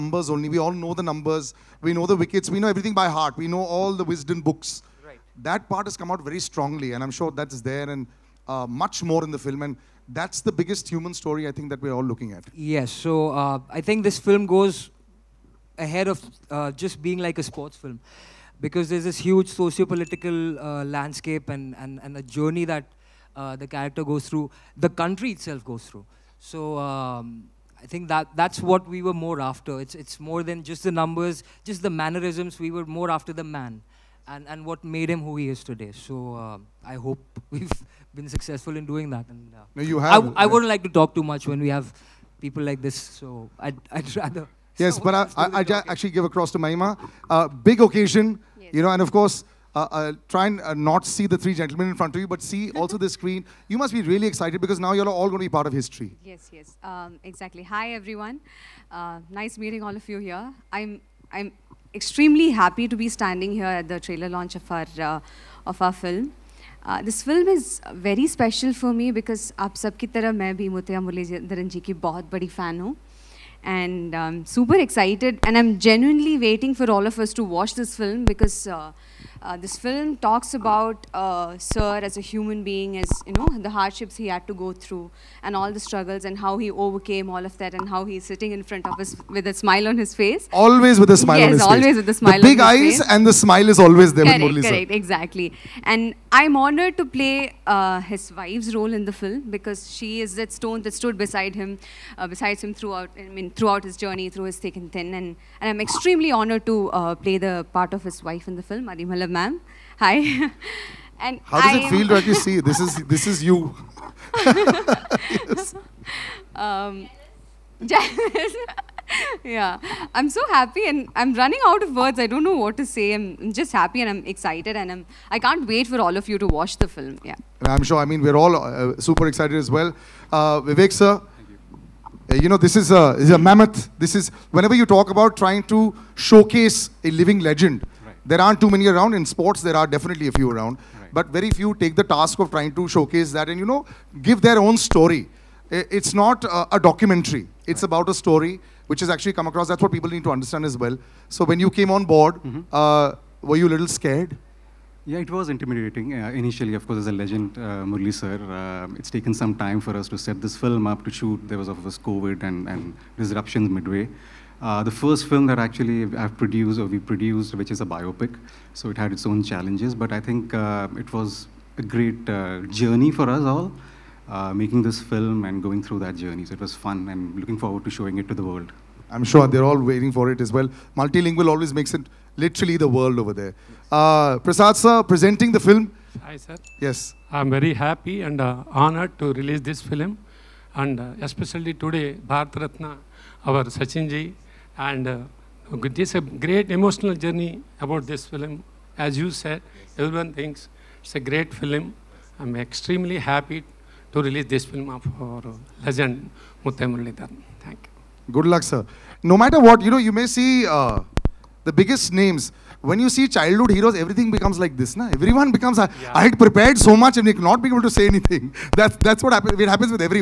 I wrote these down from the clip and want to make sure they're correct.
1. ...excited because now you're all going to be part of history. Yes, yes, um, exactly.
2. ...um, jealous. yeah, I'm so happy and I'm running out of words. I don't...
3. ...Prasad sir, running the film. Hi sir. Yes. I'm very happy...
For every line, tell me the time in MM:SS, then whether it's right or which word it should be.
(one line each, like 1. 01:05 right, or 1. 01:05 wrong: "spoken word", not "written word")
1. 00:54 right
2. 01:56 right
3. 03:04 wrong: "presenting", not "running".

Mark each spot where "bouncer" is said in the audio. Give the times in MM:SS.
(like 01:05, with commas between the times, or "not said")
not said.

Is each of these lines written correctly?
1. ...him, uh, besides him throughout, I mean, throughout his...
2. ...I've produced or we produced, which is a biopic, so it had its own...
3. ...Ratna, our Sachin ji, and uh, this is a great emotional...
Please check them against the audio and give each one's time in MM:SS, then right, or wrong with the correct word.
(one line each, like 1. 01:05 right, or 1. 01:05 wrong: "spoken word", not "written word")
1. 01:41 right
2. 02:46 right
3. 03:12 right.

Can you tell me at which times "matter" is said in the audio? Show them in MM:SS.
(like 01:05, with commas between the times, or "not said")
03:29.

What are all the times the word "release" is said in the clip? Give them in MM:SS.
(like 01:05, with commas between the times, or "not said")
03:09, 03:24.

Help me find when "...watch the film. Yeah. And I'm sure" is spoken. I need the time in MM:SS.
02:06.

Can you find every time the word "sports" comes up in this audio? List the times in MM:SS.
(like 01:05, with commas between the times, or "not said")
00:17, 02:19.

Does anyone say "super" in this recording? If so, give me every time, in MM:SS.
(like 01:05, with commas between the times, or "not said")
01:14, 02:08.